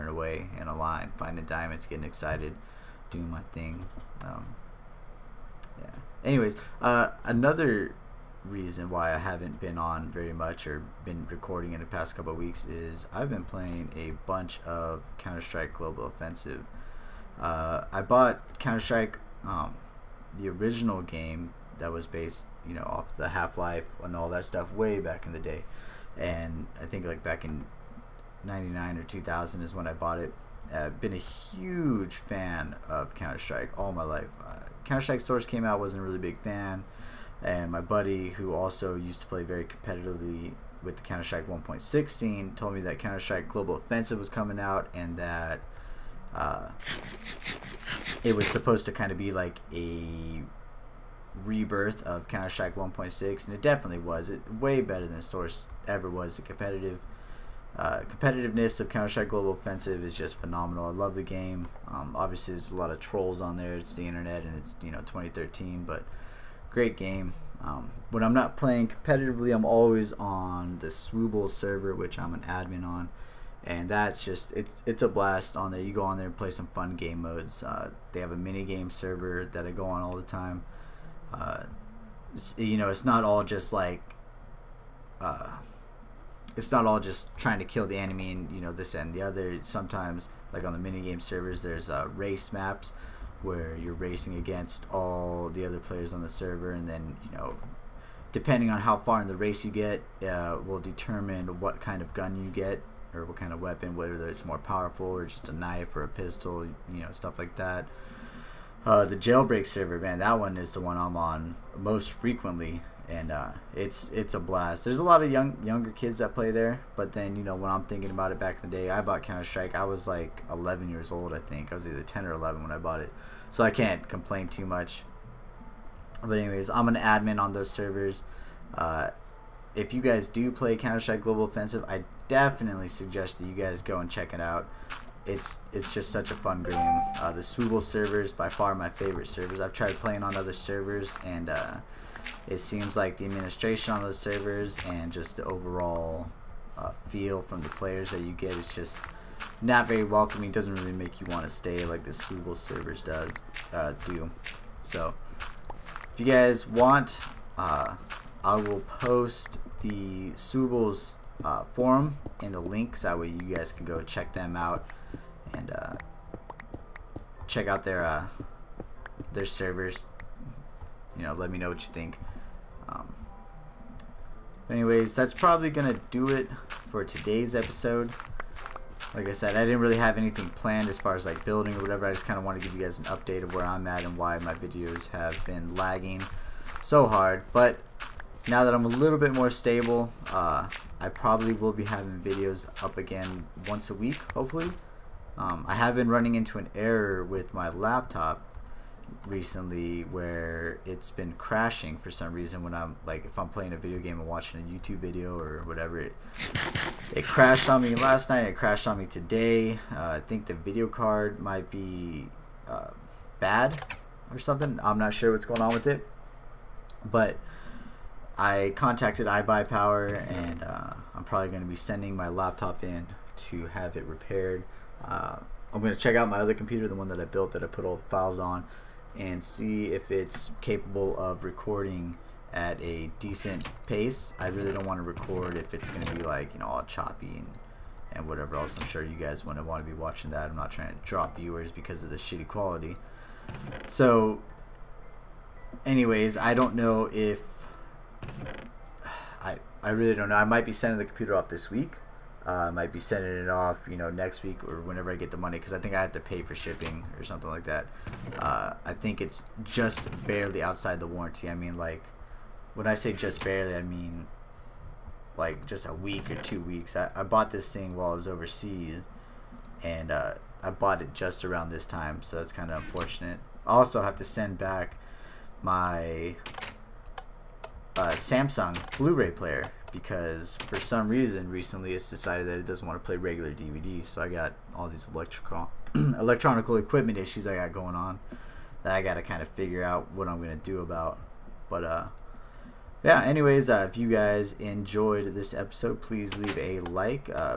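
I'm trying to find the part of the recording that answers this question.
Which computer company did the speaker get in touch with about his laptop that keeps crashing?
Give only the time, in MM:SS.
03:39.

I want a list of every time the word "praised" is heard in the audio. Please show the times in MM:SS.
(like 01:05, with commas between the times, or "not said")
not said.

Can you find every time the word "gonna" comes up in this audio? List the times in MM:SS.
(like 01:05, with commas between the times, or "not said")
02:55, 04:50.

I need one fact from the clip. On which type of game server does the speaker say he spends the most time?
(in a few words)
jailbreak.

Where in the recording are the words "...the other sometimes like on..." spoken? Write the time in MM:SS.
01:29.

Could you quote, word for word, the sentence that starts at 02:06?
But anyways, I'm an admin on those servers.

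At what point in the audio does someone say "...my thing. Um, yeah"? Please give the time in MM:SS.
00:03.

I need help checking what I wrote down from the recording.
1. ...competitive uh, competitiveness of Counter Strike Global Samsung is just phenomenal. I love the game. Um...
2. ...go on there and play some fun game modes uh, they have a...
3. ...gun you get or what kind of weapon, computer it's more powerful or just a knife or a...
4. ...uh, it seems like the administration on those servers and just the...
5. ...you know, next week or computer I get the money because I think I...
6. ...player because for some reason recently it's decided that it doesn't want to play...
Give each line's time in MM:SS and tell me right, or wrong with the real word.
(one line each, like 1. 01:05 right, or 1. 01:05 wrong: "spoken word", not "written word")
1. 00:56 wrong: "Offensive", not "Samsung"
2. 01:15 right
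3. 01:42 wrong: "whether", not "computer"
4. 02:21 right
5. 04:13 wrong: "whenever", not "computer"
6. 04:39 right.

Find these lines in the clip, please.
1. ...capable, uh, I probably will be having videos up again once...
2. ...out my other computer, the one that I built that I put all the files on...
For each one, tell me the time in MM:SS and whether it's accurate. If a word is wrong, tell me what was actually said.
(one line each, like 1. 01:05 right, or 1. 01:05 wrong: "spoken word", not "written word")
1. 03:09 wrong: "stable", not "capable"
2. 03:46 right.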